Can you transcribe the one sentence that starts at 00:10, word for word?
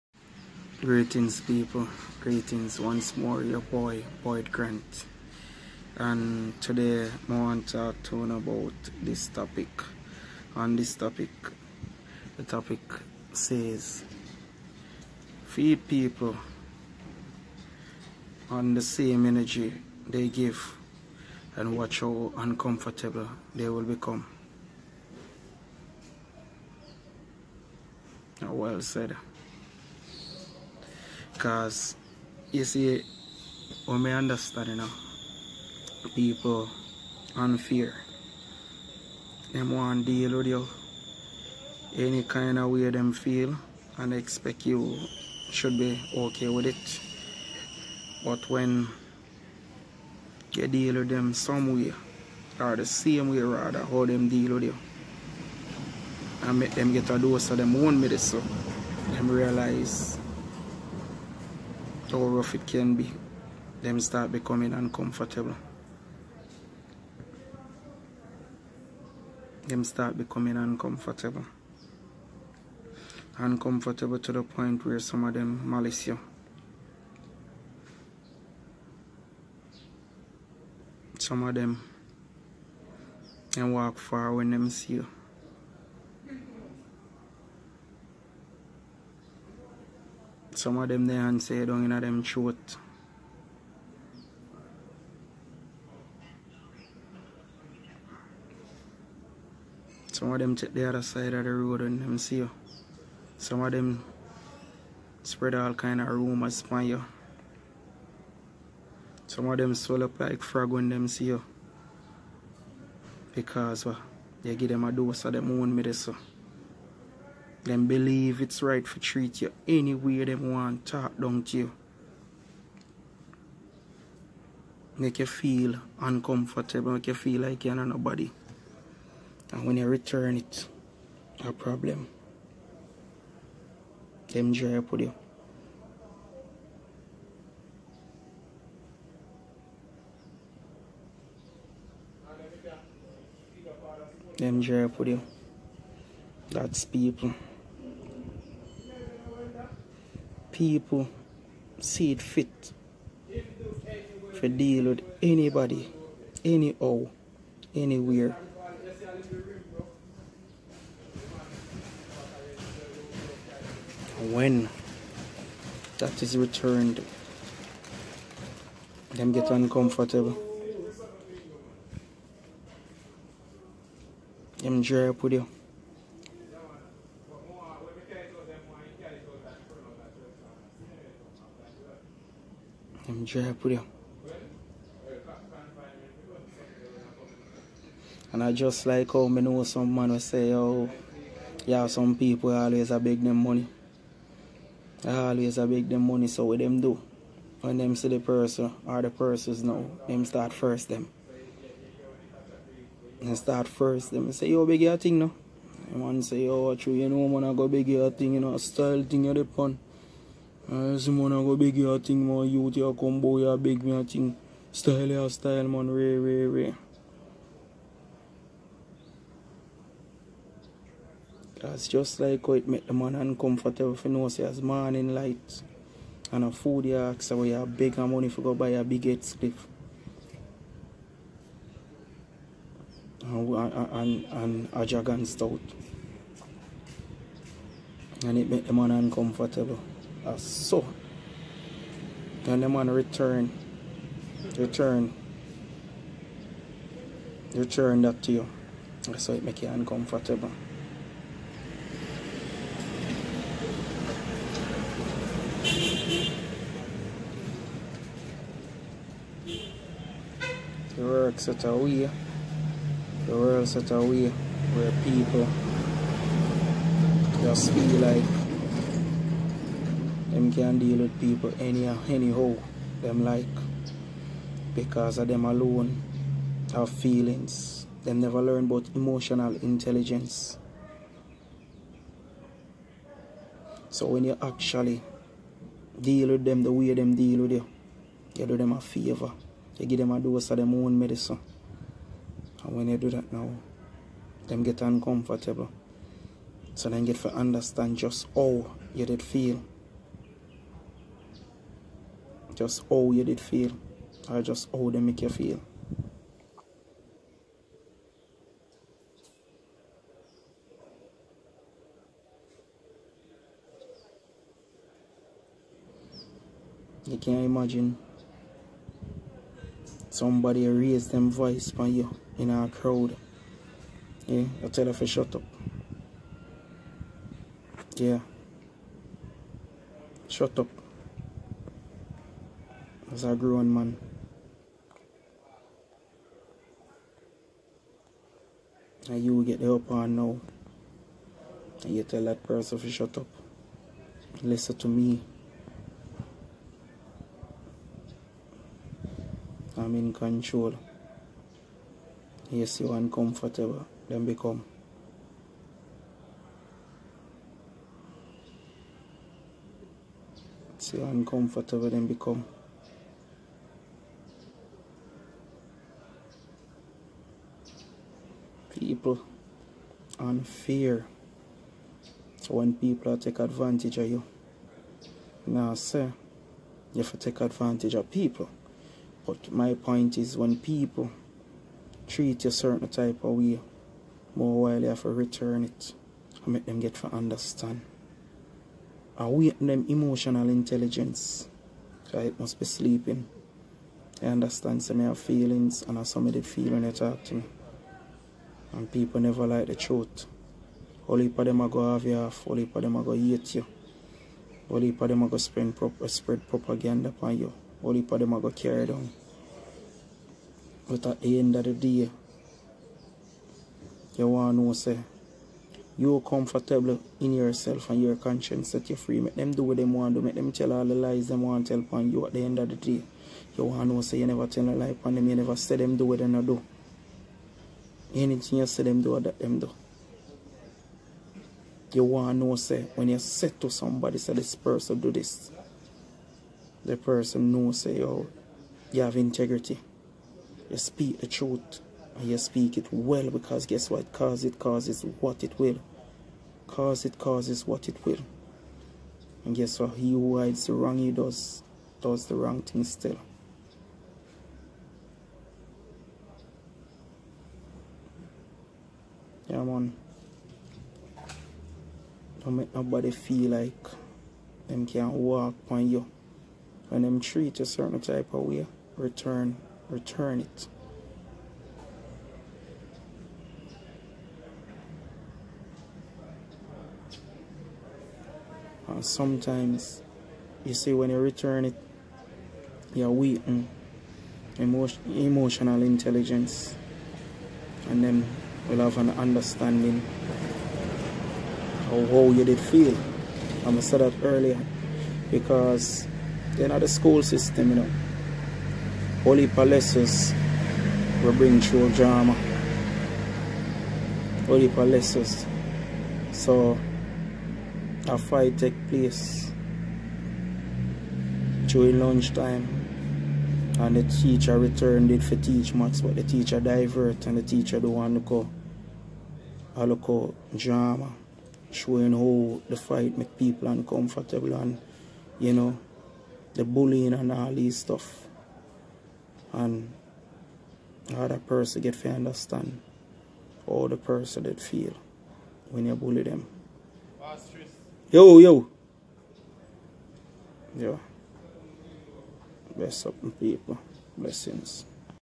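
On this topic, the topic says feed people on the same energy they give and watch how uncomfortable they will become.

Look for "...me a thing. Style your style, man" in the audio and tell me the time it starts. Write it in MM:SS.
03:33.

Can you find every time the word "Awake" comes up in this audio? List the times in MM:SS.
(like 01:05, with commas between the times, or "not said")
06:29.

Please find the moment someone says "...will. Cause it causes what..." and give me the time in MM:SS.
07:25.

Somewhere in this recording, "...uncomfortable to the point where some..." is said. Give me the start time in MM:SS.
01:13.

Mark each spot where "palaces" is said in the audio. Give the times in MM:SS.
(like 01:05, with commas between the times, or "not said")
08:19, 08:24.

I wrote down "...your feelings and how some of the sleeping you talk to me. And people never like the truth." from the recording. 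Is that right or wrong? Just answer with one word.
wrong.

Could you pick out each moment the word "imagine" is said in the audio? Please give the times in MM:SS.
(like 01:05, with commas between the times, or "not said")
05:17.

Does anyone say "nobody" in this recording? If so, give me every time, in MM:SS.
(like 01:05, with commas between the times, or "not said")
02:07, 07:42.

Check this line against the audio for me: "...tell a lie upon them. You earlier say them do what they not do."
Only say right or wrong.
wrong.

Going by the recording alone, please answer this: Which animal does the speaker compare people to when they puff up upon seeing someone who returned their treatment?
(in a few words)
frog.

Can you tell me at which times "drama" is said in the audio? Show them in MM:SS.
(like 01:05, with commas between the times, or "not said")
08:21, 08:40.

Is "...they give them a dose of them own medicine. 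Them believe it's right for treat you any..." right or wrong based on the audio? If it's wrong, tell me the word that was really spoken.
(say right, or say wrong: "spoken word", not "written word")
right.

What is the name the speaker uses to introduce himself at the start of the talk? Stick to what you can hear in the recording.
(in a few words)
Boyd Grant.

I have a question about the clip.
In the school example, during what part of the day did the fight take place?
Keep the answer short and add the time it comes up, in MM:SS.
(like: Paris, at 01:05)
lunchtime, at 08:31.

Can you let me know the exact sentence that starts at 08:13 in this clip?
I'm gonna say that earlier because they're not a school system, you know.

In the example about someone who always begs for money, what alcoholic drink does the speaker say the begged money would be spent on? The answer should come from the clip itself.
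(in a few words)
Dragon Stout.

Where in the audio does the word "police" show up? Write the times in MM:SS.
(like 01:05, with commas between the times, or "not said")
not said.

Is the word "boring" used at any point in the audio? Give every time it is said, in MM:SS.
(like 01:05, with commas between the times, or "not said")
not said.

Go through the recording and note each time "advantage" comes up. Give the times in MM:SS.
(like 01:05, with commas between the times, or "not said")
06:13, 06:17.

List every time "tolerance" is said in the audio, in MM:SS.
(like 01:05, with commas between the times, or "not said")
not said.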